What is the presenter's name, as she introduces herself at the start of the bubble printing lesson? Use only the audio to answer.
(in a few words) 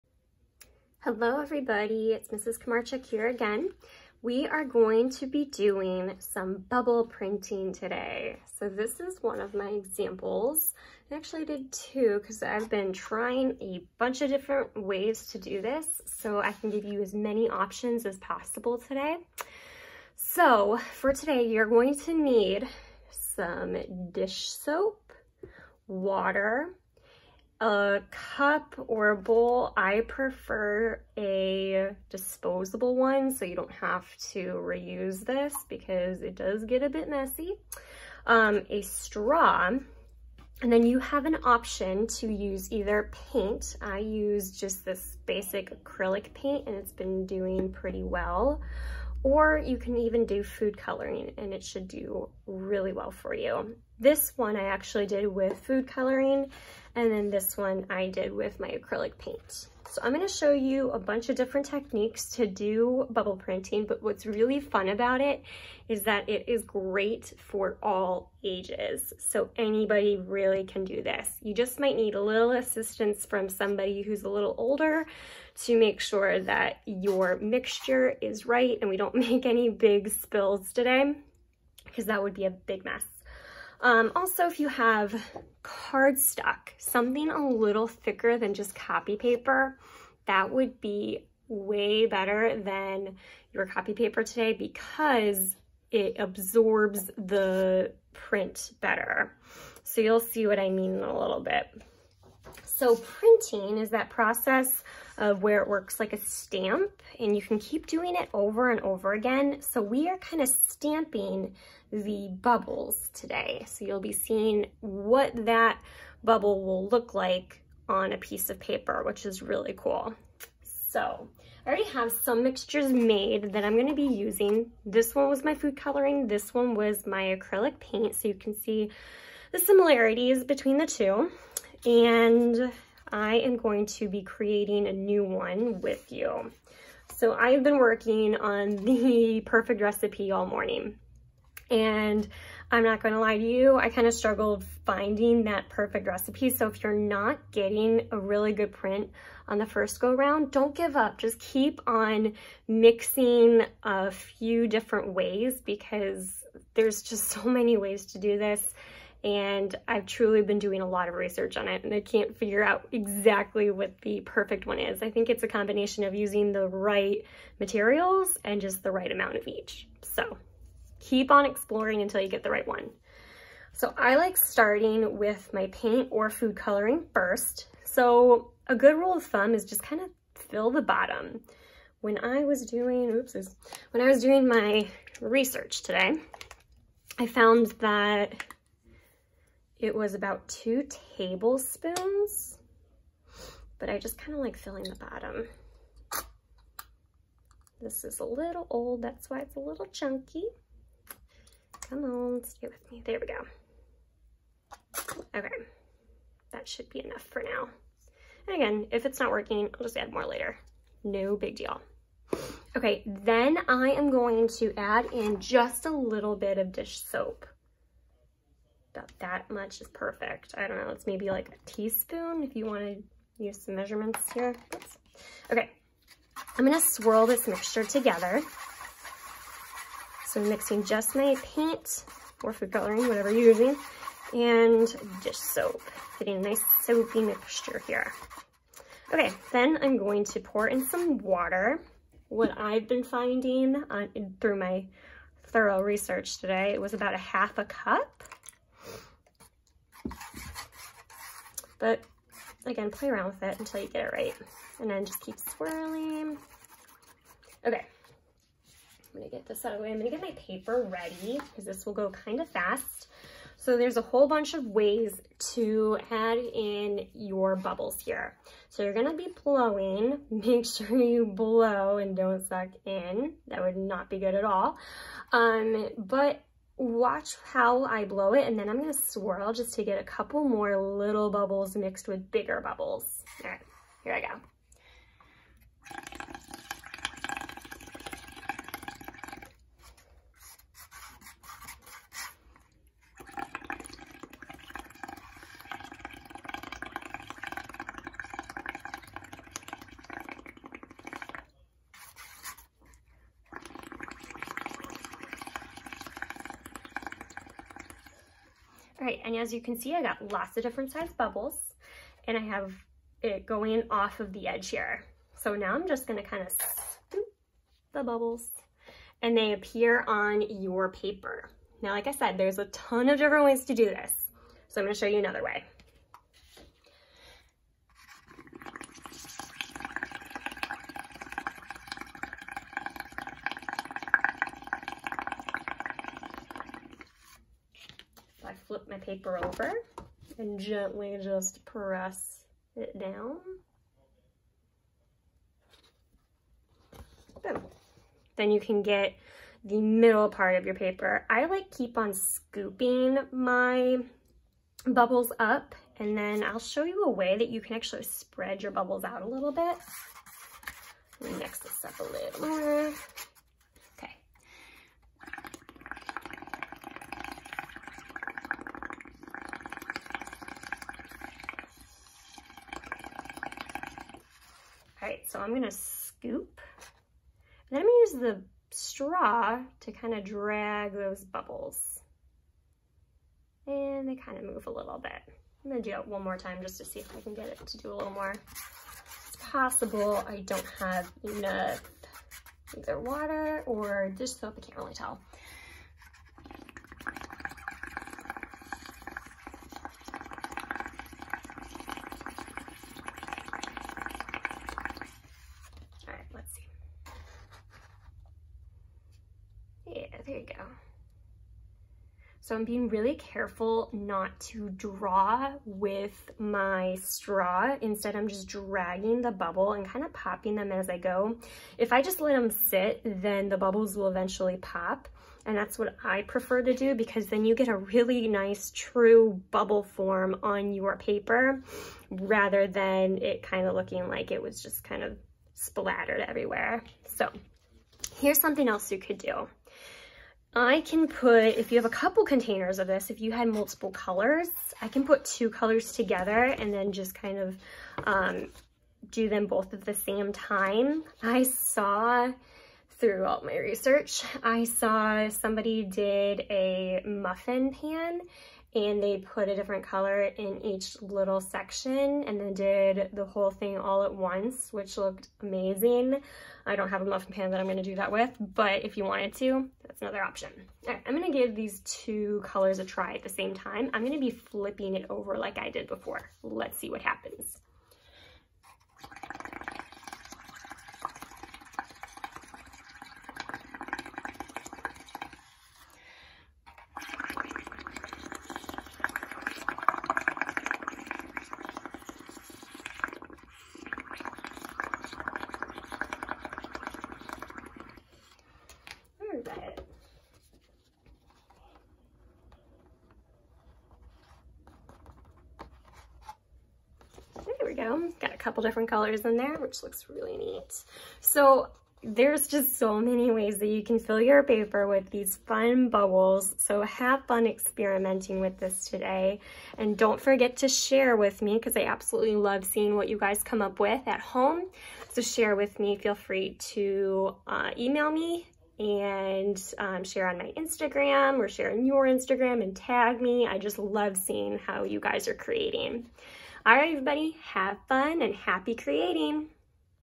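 Mrs. Komarchuk.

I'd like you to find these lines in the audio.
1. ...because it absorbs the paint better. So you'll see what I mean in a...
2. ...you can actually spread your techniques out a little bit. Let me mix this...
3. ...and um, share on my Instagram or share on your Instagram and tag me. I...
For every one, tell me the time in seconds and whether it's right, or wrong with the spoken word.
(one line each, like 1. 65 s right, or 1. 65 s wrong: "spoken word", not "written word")
1. 94 s wrong: "print", not "paint"
2. 357 s wrong: "bubbles", not "techniques"
3. 528 s right.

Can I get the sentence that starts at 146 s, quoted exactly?
So if you're not getting a really good print on the first go round, don't give up.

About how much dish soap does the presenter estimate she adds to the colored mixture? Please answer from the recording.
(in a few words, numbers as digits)
a teaspoon.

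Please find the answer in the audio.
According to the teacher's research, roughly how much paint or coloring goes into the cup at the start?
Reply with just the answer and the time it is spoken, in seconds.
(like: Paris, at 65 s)
2 tablespoons, at 190 s.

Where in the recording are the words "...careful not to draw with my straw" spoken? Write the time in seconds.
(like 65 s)
413 s.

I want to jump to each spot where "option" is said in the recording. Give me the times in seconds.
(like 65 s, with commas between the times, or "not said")
17 s, 41 s, 470 s.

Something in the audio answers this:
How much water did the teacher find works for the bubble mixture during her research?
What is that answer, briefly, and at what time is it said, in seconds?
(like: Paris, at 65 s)
half a cup, at 247 s.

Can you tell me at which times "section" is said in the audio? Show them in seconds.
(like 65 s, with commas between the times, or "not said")
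461 s.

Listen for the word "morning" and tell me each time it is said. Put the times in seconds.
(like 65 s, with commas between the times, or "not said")
140 s.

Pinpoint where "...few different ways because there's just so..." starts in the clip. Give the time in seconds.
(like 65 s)
154 s.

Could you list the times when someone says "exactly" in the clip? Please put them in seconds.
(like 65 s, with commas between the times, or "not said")
162 s.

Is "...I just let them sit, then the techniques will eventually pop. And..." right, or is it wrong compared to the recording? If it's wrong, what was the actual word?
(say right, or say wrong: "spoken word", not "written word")
wrong: "bubbles", not "techniques".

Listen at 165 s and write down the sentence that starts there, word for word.
I think it's a combination of using the right materials and just the right amount of each.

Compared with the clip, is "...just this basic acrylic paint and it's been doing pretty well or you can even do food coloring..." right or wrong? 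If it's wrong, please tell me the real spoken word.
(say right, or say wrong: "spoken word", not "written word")
right.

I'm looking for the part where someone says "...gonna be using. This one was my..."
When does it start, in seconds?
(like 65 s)
123 s.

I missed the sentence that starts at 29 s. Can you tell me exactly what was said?
I prefer a disposable one so you don't have to reuse this because it does get a bit messy.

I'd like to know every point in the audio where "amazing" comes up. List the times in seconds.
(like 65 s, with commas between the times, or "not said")
465 s.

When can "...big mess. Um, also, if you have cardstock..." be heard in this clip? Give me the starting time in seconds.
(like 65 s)
82 s.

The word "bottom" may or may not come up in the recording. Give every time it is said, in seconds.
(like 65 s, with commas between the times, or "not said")
180 s, 194 s.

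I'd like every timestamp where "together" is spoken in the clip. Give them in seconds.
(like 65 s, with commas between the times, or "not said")
227 s, 445 s.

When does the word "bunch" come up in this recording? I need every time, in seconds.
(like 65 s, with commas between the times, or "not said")
13 s, 60 s, 264 s.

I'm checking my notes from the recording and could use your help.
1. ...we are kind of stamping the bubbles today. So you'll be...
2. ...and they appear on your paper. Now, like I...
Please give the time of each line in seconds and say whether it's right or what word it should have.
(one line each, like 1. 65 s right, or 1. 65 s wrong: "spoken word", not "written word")
1. 109 s right
2. 319 s right.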